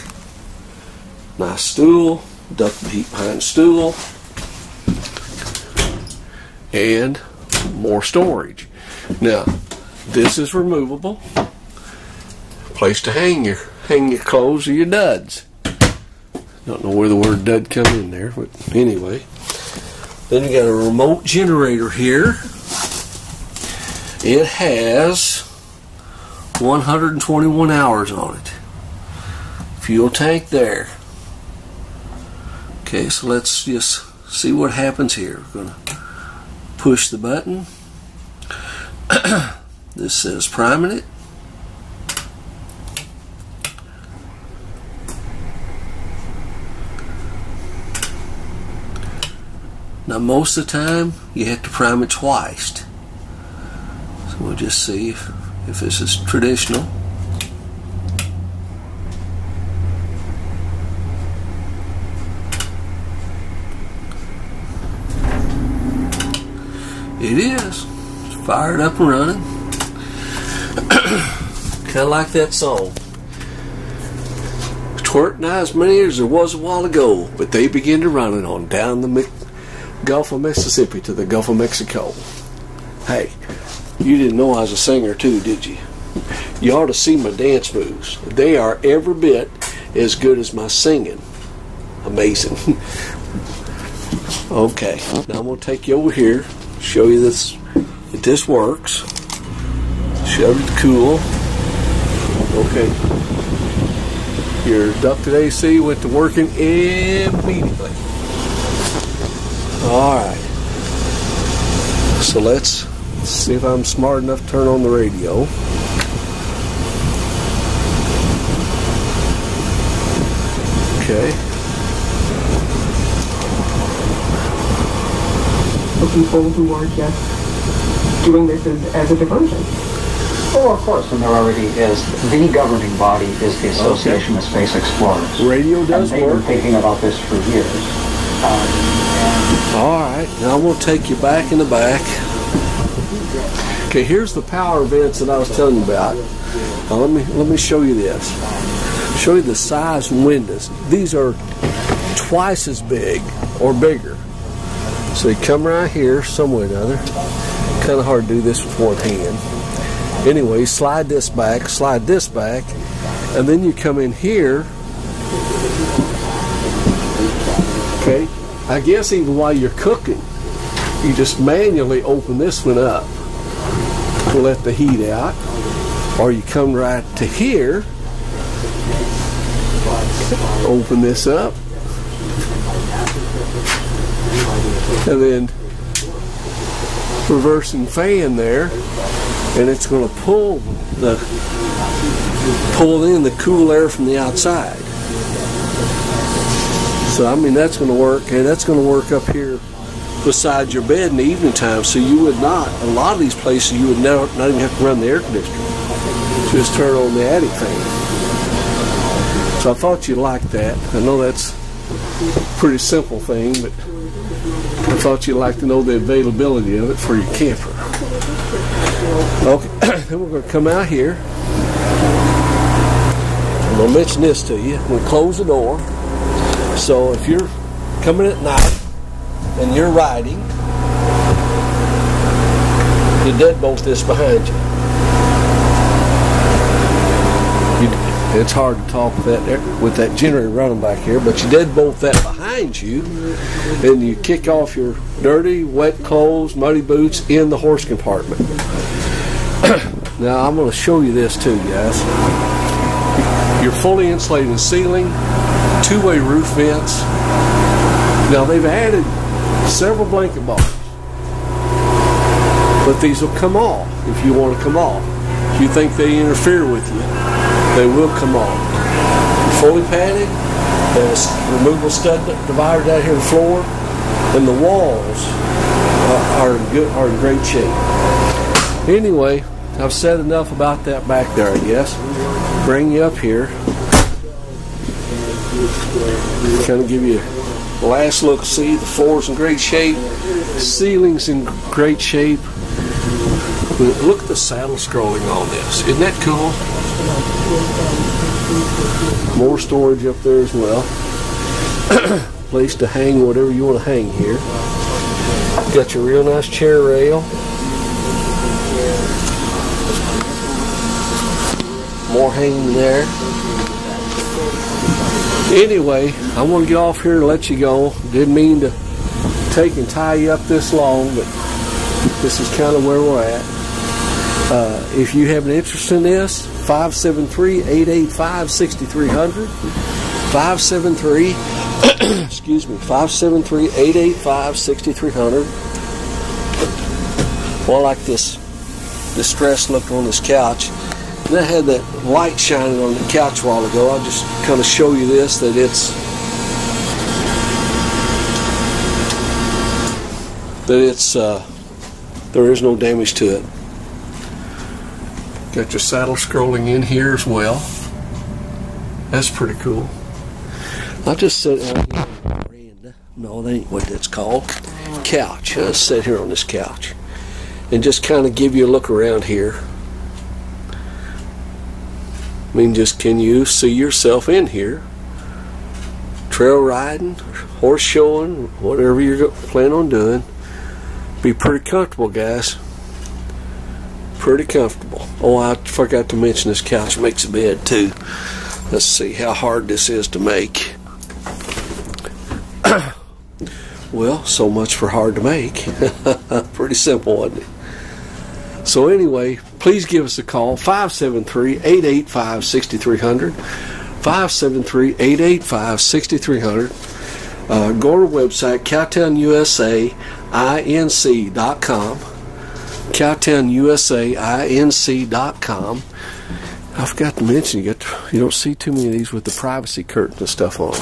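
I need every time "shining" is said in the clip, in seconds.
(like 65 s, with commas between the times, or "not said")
342 s.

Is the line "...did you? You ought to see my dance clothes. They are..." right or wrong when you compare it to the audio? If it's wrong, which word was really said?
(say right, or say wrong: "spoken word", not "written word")
wrong: "moves", not "clothes".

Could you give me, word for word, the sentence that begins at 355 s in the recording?
Got your saddle scrolling in here as well.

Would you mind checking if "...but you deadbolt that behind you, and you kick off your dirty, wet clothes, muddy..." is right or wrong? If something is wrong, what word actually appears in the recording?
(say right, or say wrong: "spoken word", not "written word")
right.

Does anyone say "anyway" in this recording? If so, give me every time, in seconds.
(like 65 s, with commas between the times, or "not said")
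18 s, 160 s, 278 s, 315 s, 398 s.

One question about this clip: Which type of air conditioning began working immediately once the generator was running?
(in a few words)
ducted AC.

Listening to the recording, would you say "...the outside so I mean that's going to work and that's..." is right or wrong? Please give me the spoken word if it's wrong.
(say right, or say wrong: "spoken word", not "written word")
right.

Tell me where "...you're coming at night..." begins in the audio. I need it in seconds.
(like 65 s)
227 s.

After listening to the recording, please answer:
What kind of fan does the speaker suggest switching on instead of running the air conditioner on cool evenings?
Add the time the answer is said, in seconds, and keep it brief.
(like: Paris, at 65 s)
attic fan, at 207 s.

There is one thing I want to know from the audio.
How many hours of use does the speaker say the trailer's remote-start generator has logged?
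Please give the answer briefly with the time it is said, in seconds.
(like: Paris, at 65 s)
121, at 26 s.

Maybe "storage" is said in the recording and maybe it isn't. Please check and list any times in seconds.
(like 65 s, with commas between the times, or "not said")
8 s, 299 s.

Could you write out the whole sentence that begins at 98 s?
If this works, shove it cool.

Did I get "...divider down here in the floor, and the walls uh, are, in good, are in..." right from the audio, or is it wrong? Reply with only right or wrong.
right.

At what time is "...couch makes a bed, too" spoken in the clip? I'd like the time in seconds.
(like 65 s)
386 s.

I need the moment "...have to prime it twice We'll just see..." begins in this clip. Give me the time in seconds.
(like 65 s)
51 s.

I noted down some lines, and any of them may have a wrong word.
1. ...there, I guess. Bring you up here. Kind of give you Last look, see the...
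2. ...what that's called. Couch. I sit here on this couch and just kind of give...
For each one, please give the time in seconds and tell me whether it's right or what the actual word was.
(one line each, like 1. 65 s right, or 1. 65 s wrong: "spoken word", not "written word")
1. 281 s right
2. 363 s right.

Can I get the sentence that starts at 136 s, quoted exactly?
been thinking about this for years.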